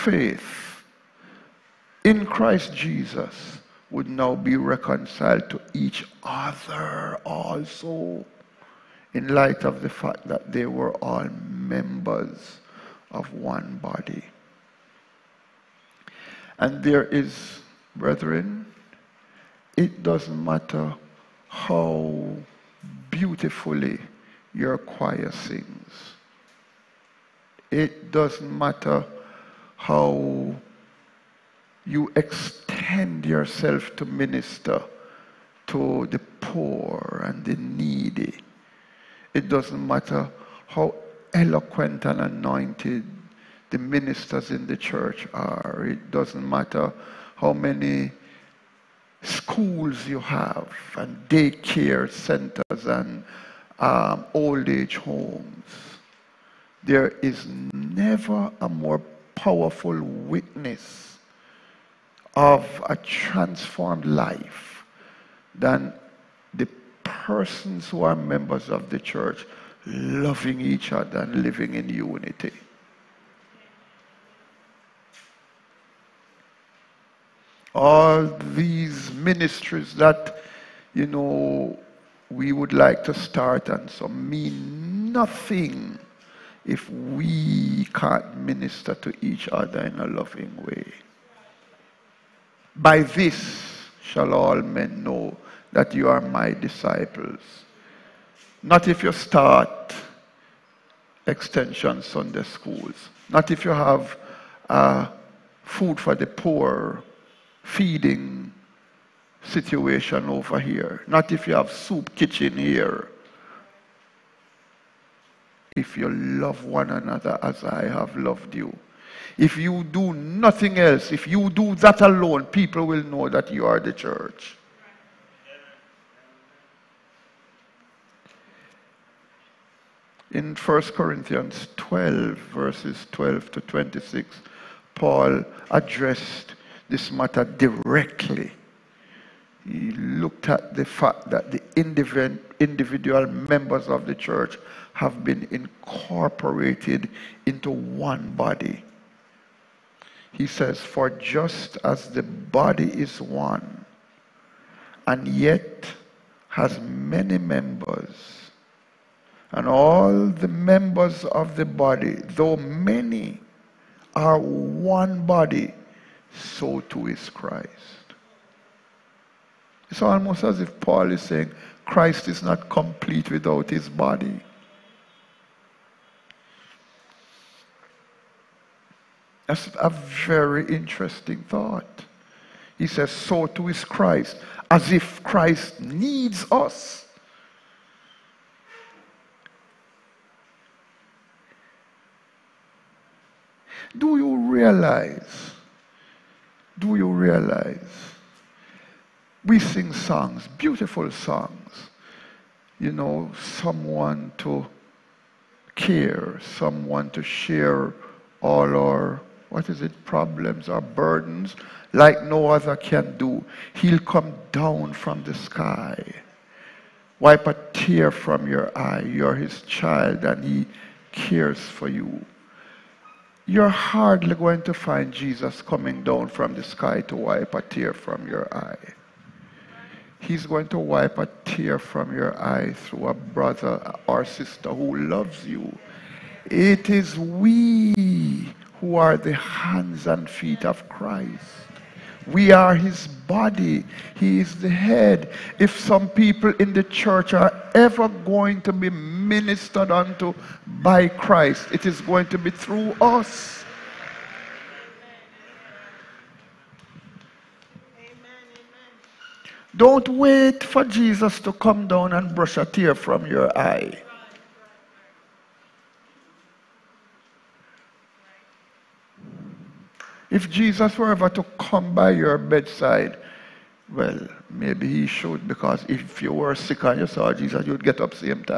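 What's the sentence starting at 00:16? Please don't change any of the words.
And there is, brethren, it doesn't matter how beautifully your choir sings.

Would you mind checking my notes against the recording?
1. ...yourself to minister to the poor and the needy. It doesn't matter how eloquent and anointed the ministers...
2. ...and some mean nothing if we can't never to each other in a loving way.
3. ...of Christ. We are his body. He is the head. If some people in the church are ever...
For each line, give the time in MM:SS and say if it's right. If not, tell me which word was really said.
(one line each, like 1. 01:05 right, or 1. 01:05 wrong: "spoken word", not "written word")
1. 00:33 right
2. 01:23 wrong: "minister", not "never"
3. 04:00 right.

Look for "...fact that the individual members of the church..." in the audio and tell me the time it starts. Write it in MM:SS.
02:20.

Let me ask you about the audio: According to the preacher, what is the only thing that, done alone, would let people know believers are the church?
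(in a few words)
Love one another.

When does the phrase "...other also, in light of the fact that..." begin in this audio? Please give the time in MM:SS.
00:06.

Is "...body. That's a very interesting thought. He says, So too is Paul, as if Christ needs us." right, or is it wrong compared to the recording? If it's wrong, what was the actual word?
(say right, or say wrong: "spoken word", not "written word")
wrong: "Christ", not "Paul".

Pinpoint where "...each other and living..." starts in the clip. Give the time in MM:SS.
01:10.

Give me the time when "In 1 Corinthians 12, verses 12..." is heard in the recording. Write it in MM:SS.
02:10.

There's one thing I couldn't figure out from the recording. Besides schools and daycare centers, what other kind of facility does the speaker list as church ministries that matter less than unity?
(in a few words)
Old age homes.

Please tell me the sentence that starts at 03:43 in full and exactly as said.
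You're hardly going to find Jesus coming down from the sky to wipe a tear from your eye.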